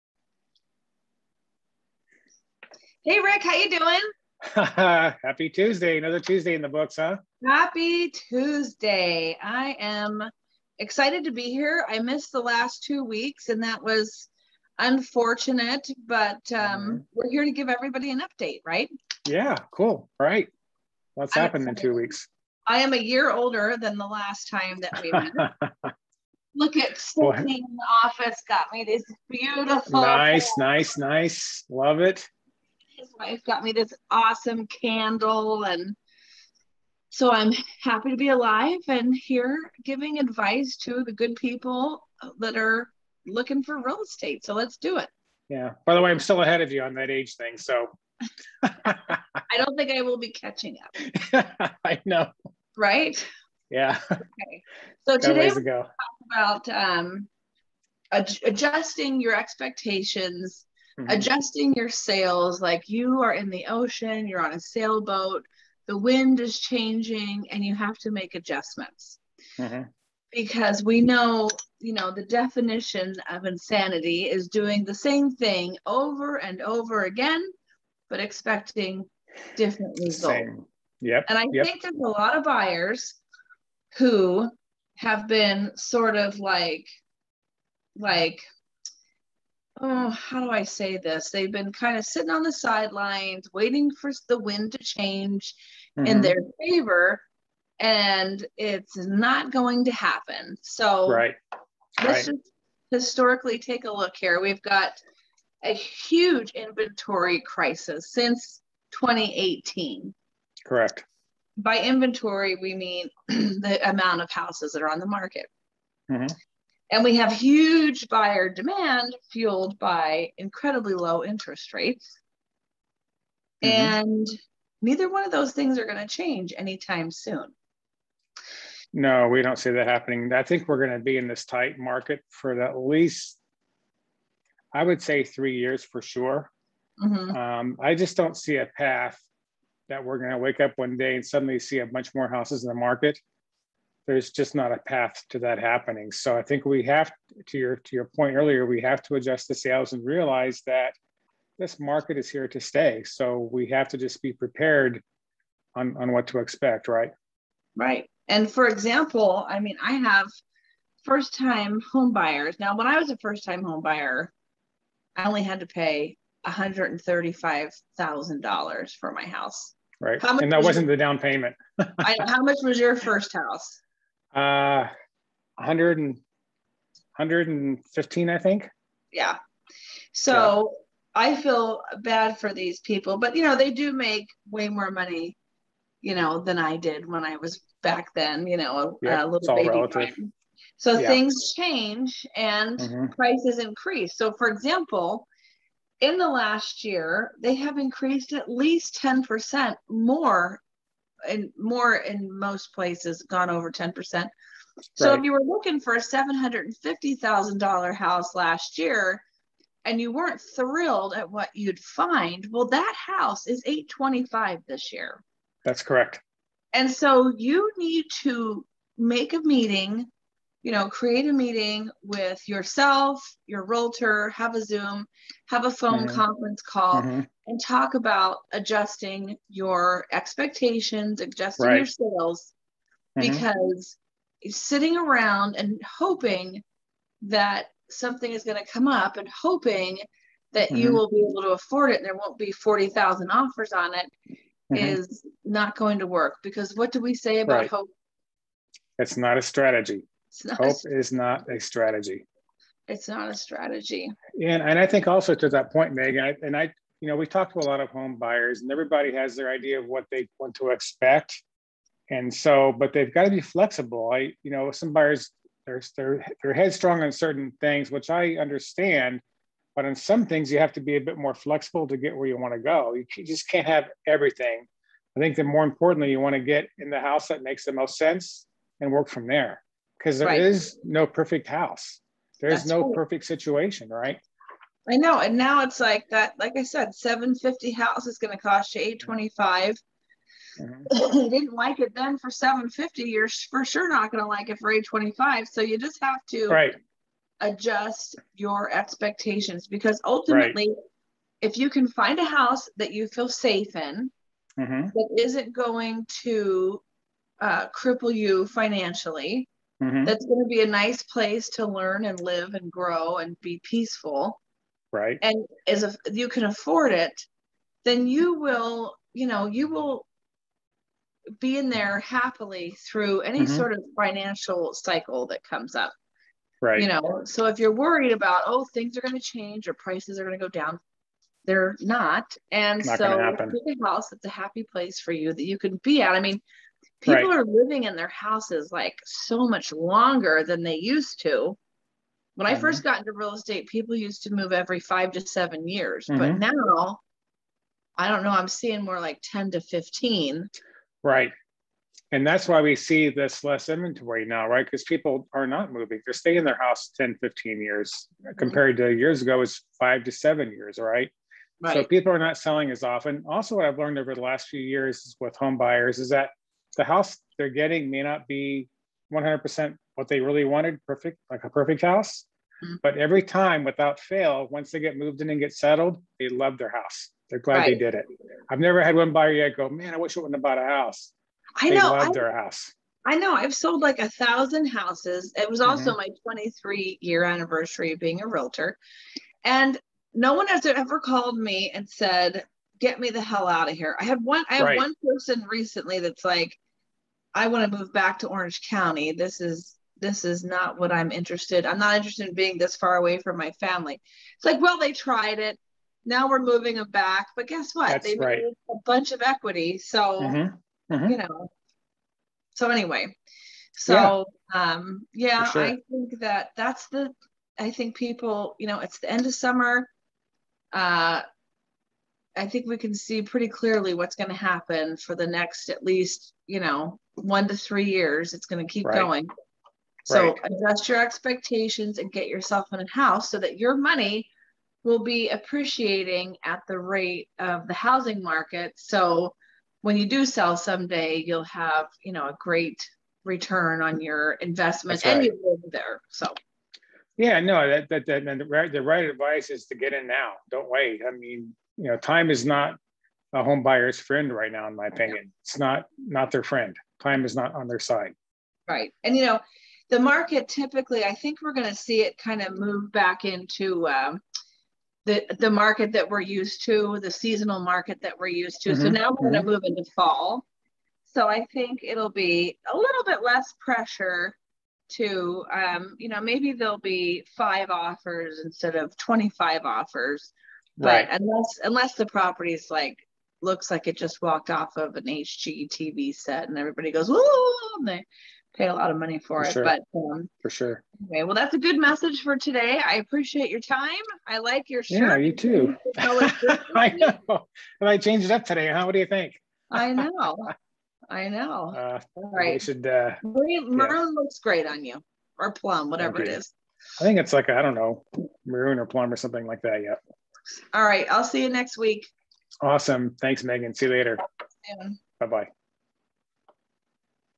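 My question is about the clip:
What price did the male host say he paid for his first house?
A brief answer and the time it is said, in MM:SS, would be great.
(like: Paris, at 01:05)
115, at 02:57.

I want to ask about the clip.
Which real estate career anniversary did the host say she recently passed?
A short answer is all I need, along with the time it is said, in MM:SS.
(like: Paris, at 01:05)
23 year, at 06:26.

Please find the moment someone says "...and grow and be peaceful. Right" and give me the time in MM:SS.
05:12.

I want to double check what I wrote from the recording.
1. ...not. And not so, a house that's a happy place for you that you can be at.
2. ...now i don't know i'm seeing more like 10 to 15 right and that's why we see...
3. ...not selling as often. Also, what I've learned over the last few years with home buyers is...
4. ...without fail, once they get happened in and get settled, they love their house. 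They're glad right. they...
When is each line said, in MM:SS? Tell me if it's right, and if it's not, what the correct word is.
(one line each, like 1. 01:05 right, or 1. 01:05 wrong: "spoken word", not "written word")
1. 05:31 right
2. 05:46 right
3. 06:02 right
4. 06:13 wrong: "moved", not "happened".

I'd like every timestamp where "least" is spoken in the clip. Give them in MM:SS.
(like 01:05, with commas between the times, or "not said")
02:12, 03:18, 07:05.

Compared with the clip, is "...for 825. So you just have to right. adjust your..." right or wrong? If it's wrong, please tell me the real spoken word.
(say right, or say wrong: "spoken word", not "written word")
right.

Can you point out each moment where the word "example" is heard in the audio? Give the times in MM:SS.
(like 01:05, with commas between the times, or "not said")
02:38, 03:14.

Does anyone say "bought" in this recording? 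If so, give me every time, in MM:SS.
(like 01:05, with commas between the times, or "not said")
06:20.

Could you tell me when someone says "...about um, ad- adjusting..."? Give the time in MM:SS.
00:56.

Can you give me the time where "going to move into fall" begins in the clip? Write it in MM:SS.
07:49.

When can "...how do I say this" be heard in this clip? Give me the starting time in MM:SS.
01:30.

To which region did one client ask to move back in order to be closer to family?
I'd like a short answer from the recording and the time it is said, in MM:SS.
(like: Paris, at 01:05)
Orange County, at 06:38.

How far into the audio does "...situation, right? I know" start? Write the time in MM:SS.
04:43.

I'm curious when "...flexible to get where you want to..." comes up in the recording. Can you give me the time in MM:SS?
04:31.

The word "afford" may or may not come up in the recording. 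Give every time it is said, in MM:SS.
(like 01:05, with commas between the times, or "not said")
04:01, 05:16.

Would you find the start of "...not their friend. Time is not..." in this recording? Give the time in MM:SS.
07:35.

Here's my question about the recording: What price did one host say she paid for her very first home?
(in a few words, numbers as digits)
$135,000.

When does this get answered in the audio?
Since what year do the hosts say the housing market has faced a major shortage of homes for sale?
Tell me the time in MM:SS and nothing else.
01:48.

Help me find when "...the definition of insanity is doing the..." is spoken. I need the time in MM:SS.
01:12.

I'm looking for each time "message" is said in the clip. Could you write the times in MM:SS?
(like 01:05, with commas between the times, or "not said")
08:11.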